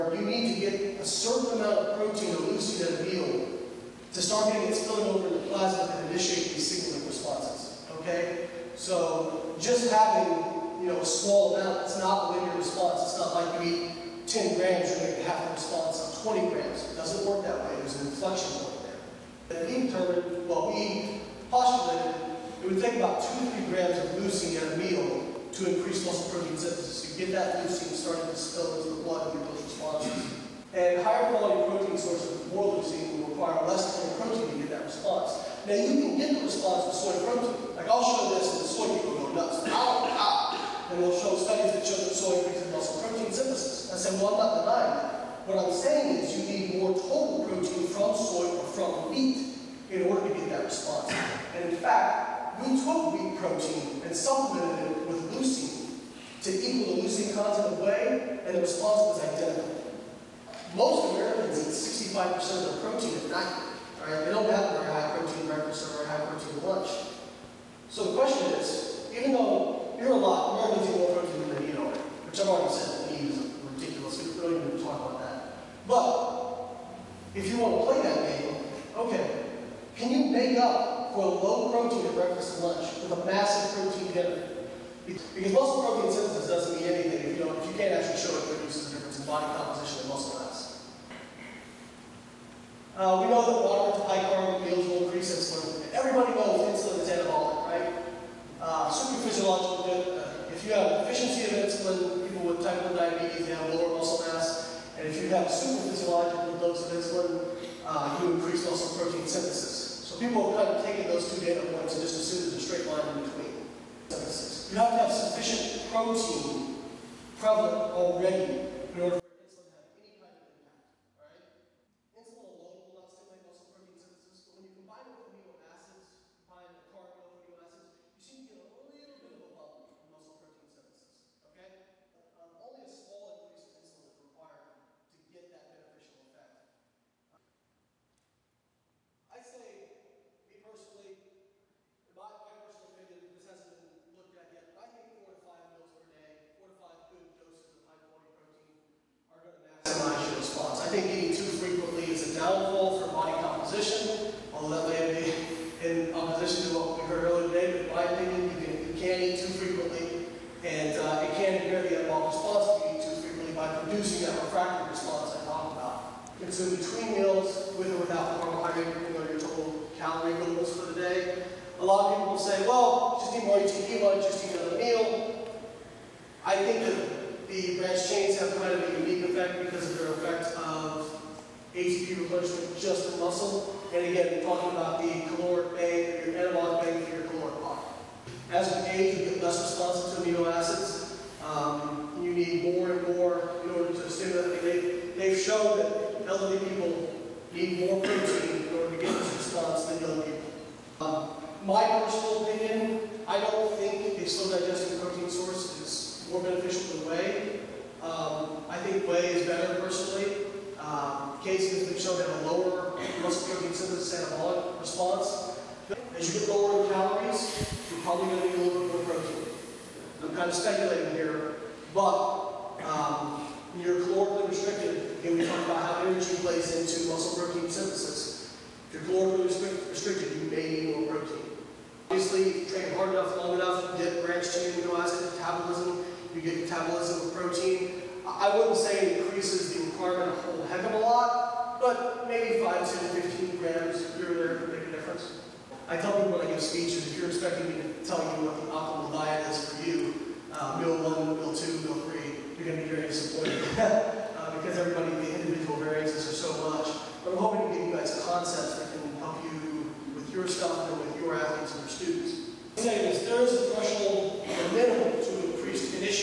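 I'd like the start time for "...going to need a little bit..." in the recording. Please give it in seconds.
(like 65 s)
218 s.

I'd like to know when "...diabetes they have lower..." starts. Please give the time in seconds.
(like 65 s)
102 s.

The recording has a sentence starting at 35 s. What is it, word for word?
Now you can get the response with soy protein.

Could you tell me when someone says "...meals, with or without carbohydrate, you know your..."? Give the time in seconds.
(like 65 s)
167 s.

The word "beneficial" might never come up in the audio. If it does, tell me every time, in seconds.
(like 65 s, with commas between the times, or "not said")
135 s, 206 s.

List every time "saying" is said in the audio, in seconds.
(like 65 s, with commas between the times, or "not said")
45 s, 262 s.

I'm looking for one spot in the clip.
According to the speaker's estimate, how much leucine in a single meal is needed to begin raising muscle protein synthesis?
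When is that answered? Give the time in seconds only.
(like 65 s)
23 s.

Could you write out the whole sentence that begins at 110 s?
So people have kind of taken those two data points and just assumed there's a straight line in between.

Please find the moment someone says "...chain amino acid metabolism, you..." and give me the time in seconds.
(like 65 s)
234 s.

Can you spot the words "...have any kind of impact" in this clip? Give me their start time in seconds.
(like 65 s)
119 s.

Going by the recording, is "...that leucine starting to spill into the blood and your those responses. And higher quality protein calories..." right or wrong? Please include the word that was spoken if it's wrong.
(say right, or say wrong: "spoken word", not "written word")
wrong: "sources", not "calories".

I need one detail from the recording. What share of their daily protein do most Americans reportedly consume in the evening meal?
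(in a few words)
65%.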